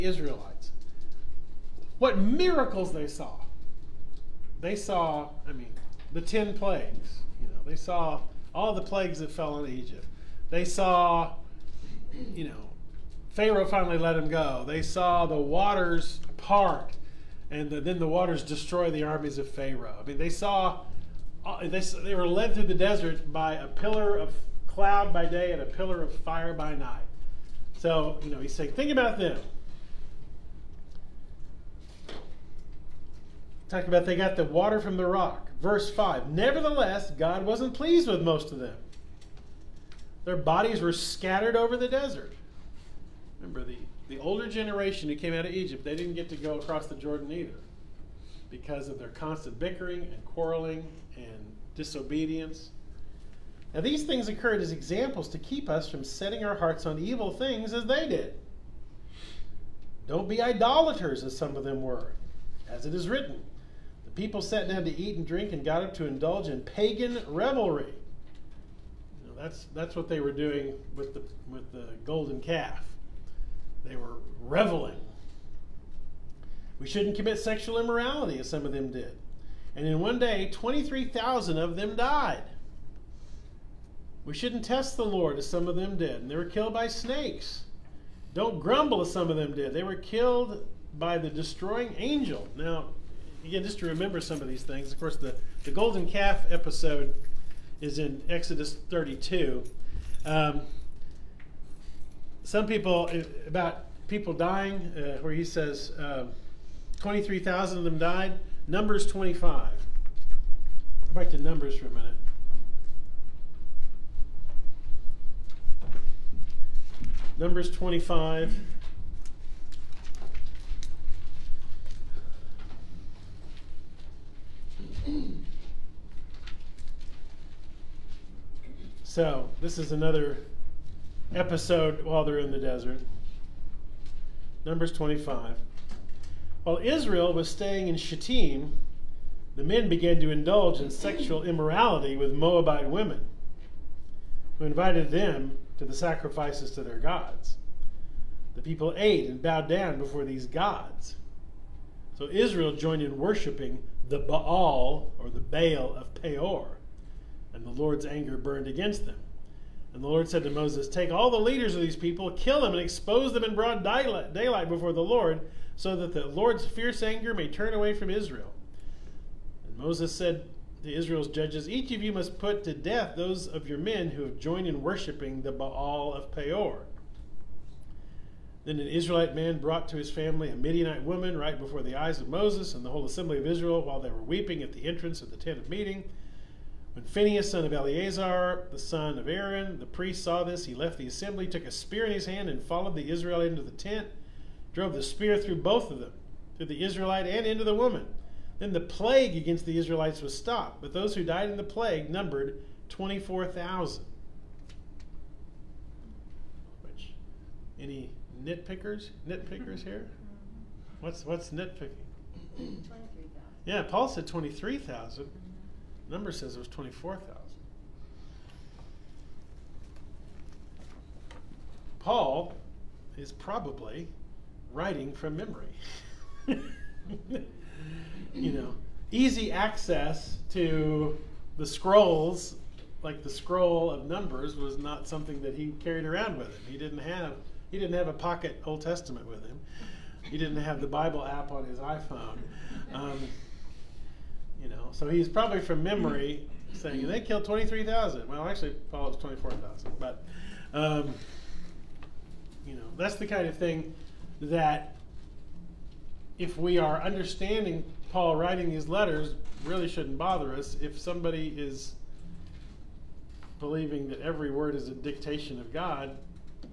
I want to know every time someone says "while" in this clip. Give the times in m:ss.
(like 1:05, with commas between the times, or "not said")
2:12, 2:16, 3:03.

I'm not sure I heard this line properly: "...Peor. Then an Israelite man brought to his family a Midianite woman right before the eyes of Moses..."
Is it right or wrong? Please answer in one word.
right.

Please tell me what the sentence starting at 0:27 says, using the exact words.
So, you know, he's saying, think about them.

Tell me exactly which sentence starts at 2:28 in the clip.
The people ate and bowed down before these gods.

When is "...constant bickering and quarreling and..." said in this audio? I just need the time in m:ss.
0:49.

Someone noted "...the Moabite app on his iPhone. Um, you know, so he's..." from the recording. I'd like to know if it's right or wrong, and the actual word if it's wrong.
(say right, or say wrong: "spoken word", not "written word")
wrong: "Bible", not "Moabite".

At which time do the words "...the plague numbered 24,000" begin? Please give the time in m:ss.
3:21.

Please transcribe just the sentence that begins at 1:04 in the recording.
The people sat down to eat and drink and got up to indulge in pagan revelry.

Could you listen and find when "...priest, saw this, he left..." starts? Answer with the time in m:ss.
3:09.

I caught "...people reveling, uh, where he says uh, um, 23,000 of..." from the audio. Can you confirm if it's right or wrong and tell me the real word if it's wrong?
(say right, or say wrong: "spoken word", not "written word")
wrong: "dying", not "reveling".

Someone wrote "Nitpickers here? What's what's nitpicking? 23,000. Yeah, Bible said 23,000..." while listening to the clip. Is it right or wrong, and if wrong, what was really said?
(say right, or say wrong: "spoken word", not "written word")
wrong: "Paul", not "Bible".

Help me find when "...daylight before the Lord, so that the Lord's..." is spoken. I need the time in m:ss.
2:43.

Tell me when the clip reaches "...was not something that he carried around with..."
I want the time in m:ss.
3:54.